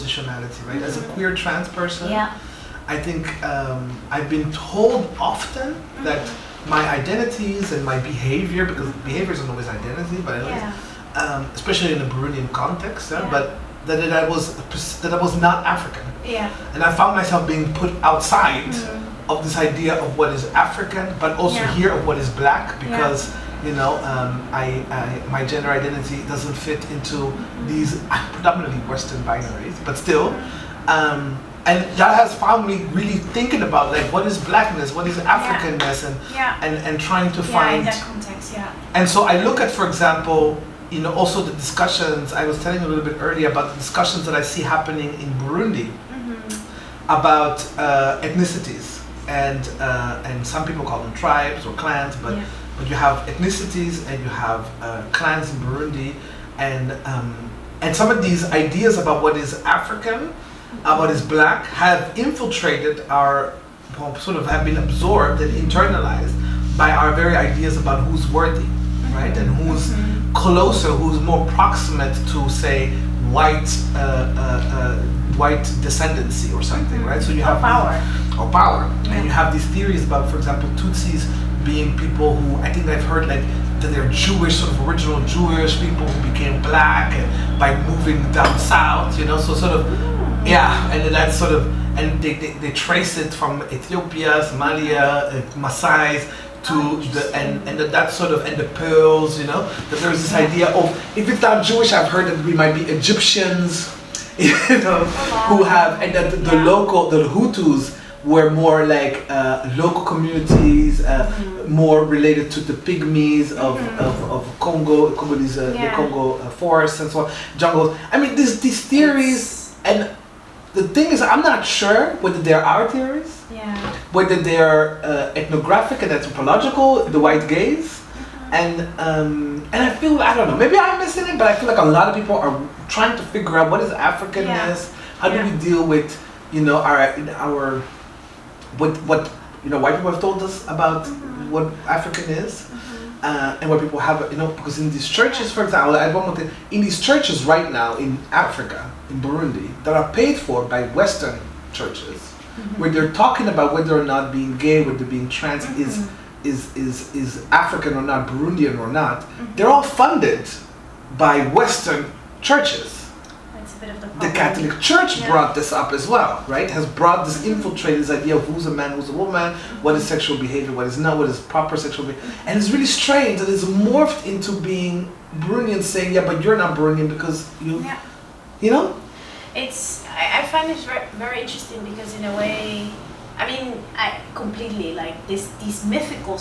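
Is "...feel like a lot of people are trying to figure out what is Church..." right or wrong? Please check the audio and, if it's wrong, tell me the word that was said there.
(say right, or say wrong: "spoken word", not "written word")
wrong: "Africanness", not "Church".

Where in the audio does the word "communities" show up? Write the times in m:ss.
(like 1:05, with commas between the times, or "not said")
1:50.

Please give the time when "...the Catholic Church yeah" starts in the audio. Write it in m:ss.
2:43.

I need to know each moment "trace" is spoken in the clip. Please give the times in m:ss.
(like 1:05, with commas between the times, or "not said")
1:32.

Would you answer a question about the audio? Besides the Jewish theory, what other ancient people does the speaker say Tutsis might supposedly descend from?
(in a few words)
Egyptians.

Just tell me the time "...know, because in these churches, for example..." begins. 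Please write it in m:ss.
2:24.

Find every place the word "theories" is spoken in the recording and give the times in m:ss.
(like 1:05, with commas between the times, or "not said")
1:19, 1:58, 2:02.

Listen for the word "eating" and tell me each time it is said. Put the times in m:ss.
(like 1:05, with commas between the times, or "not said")
not said.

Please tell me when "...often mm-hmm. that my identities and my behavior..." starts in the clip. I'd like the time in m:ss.
0:05.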